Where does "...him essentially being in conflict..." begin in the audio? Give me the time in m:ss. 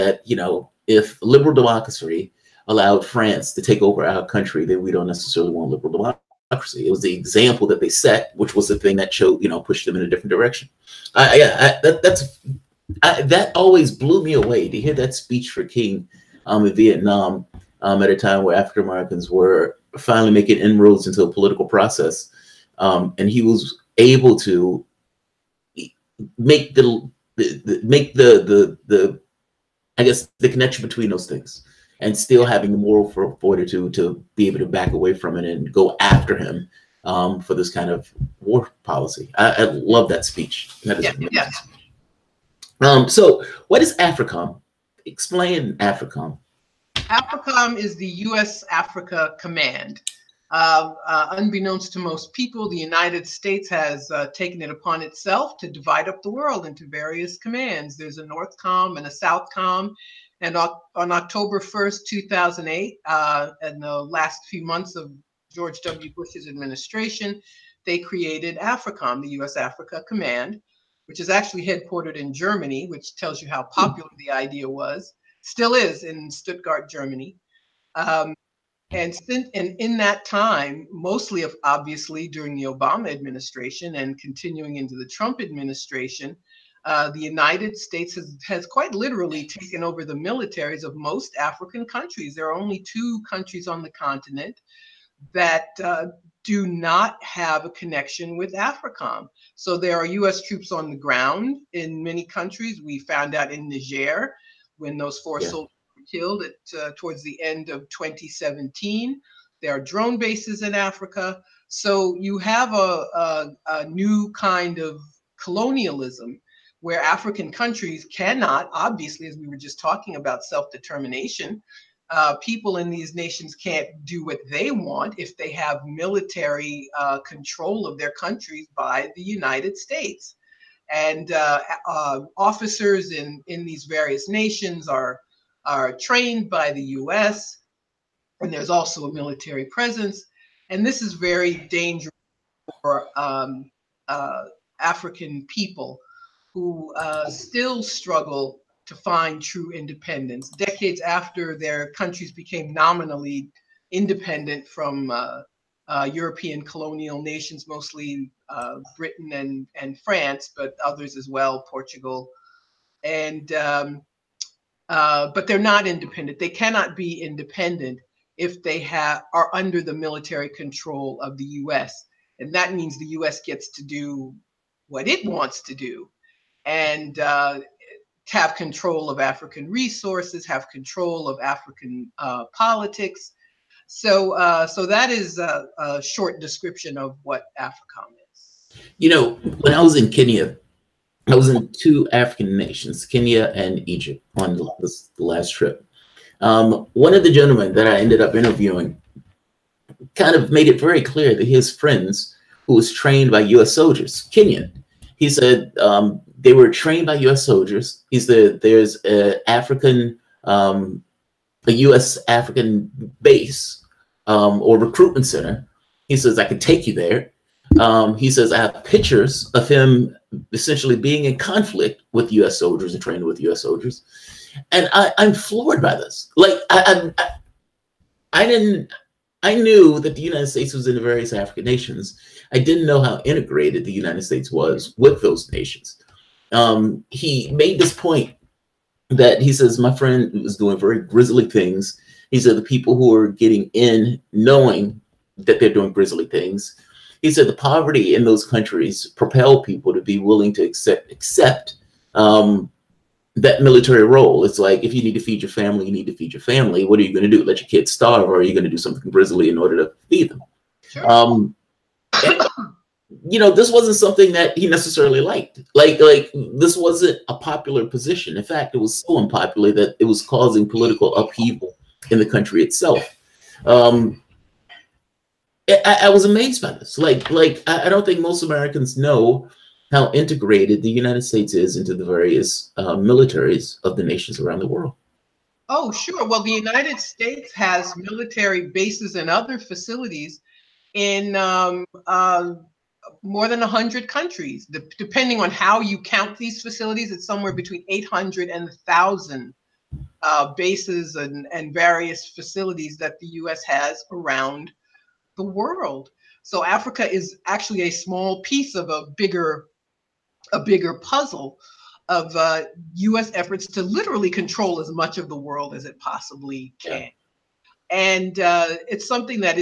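3:39.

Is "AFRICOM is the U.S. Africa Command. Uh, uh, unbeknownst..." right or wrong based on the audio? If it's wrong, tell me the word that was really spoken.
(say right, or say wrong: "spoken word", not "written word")
right.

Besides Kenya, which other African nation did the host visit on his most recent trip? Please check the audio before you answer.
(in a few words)
Egypt.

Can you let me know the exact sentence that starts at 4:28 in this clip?
In fact, it was so unpopular that it was causing political upheaval in the country itself.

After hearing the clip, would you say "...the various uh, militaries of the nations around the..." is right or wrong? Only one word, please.
right.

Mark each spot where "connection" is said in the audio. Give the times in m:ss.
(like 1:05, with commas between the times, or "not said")
0:30, 1:37.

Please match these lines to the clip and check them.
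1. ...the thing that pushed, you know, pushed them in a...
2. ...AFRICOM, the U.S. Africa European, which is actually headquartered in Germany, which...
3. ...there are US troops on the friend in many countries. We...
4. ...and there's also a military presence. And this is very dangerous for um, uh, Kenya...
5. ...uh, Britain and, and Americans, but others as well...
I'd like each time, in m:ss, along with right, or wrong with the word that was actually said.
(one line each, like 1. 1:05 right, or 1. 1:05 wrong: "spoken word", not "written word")
1. 0:08 wrong: "showed", not "pushed"
2. 1:08 wrong: "Command", not "European"
3. 1:39 wrong: "ground", not "friend"
4. 2:18 wrong: "African", not "Kenya"
5. 2:38 wrong: "France", not "Americans".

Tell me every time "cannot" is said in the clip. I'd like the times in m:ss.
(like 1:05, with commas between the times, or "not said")
1:58, 2:46.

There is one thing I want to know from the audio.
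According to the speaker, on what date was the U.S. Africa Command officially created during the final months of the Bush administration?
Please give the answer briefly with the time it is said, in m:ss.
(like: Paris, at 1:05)
October 1st, 2008, at 1:01.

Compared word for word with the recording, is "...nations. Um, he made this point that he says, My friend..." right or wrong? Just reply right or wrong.
right.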